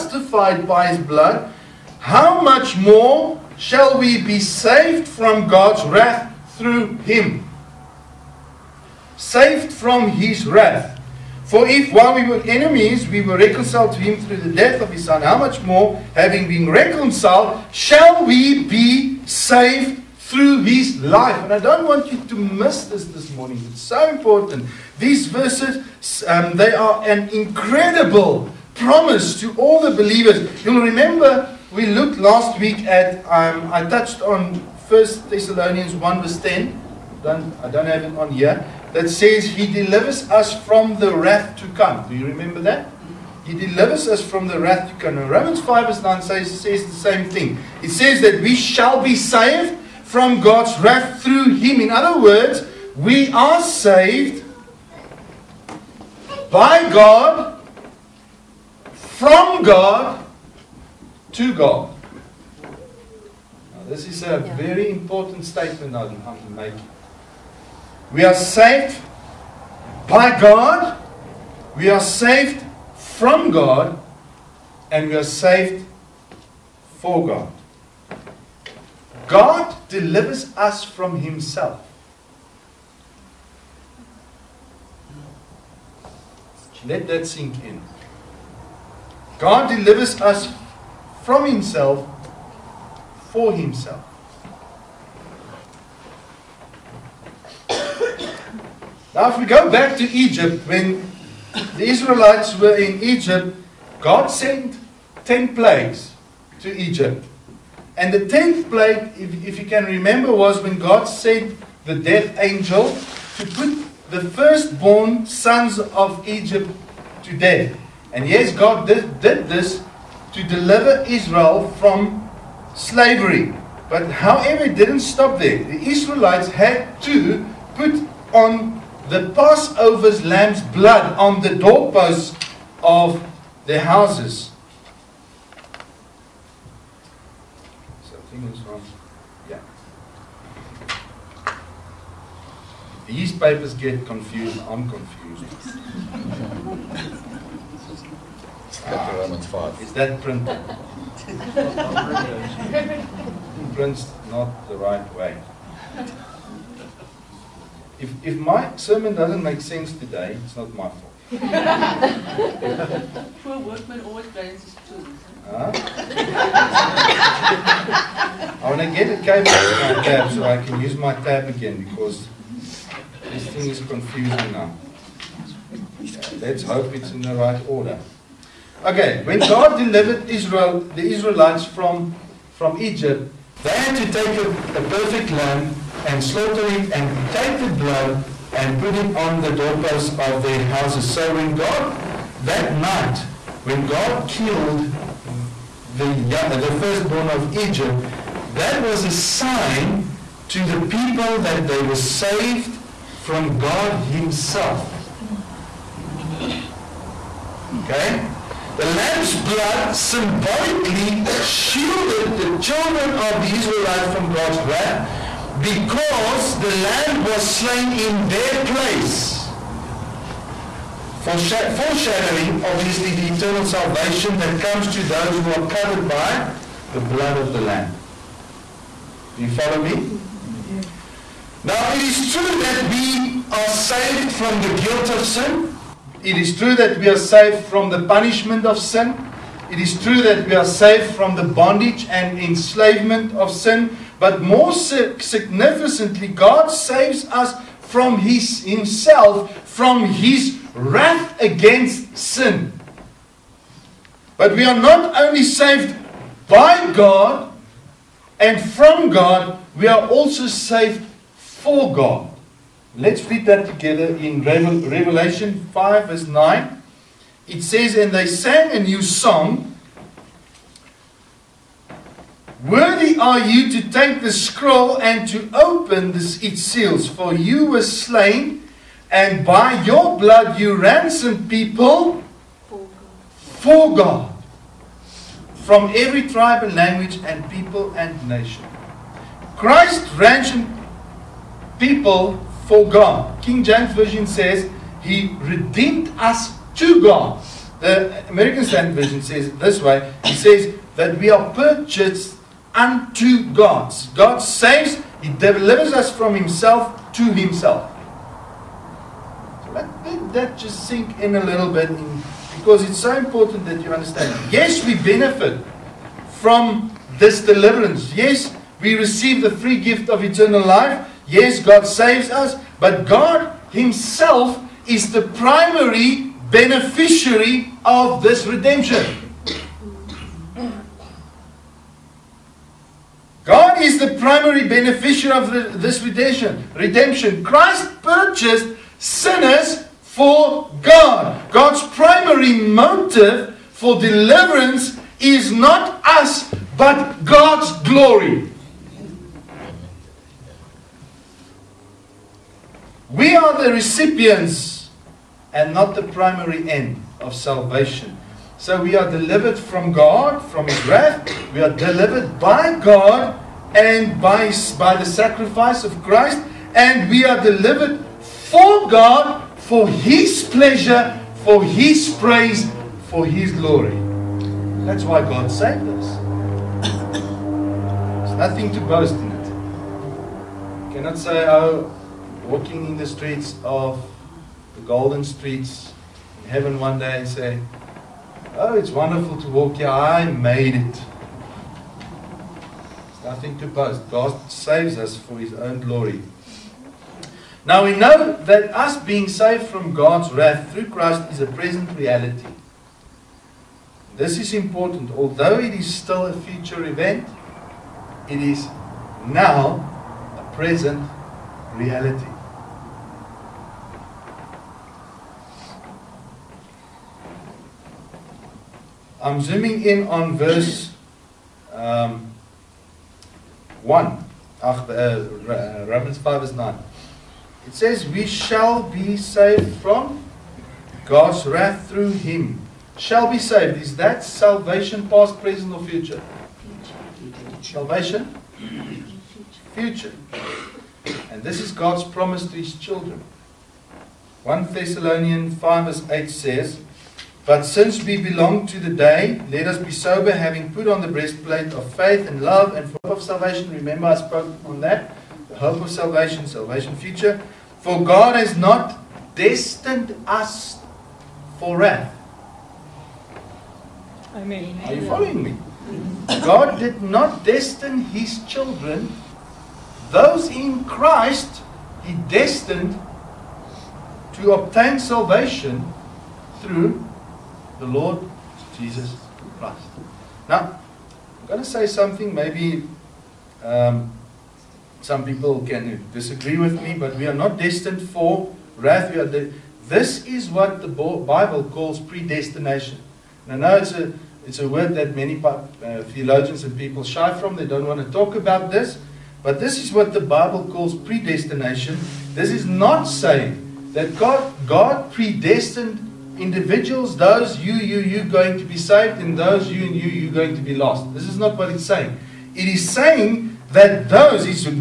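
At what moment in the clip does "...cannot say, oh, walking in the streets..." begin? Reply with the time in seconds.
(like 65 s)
380 s.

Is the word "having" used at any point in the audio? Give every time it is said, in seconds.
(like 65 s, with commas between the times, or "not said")
16 s, 450 s.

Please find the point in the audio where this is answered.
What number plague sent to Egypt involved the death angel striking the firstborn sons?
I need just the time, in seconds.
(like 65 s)
108 s.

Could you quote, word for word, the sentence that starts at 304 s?
God saves, He delivers us from Himself to Himself.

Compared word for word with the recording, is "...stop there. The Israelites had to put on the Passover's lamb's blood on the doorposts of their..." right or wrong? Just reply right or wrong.
right.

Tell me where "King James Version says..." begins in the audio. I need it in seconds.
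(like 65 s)
293 s.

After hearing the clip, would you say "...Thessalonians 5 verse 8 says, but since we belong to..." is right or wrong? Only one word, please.
right.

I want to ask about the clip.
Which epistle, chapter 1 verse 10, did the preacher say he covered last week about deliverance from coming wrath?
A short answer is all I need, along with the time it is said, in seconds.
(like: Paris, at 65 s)
First Thessalonians, at 34 s.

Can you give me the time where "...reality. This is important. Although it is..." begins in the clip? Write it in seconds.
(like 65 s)
401 s.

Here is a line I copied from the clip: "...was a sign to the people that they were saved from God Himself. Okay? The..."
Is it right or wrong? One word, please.
right.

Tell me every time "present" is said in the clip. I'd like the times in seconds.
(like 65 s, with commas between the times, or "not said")
401 s, 410 s, 435 s.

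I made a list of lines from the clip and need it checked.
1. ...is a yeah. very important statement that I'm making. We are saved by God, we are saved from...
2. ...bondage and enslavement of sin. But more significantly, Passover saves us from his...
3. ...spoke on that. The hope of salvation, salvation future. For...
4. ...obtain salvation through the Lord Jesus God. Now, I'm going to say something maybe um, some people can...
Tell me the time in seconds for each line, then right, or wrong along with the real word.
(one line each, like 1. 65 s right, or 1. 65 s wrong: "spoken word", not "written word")
1. 64 s right
2. 241 s wrong: "God", not "Passover"
3. 454 s right
4. 474 s wrong: "Christ", not "God".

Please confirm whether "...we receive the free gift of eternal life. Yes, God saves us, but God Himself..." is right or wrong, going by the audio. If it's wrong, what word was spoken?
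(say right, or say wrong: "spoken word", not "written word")
right.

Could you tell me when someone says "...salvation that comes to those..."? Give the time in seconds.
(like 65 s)
223 s.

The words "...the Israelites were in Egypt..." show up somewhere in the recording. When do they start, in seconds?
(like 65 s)
101 s.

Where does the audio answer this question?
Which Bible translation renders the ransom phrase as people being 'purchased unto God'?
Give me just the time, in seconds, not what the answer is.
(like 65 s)
298 s.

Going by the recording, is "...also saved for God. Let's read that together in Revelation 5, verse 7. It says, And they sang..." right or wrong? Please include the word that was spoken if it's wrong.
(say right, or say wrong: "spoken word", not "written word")
wrong: "9", not "7".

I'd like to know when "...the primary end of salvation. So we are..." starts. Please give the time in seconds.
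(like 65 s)
355 s.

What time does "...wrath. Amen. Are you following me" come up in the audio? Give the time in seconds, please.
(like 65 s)
461 s.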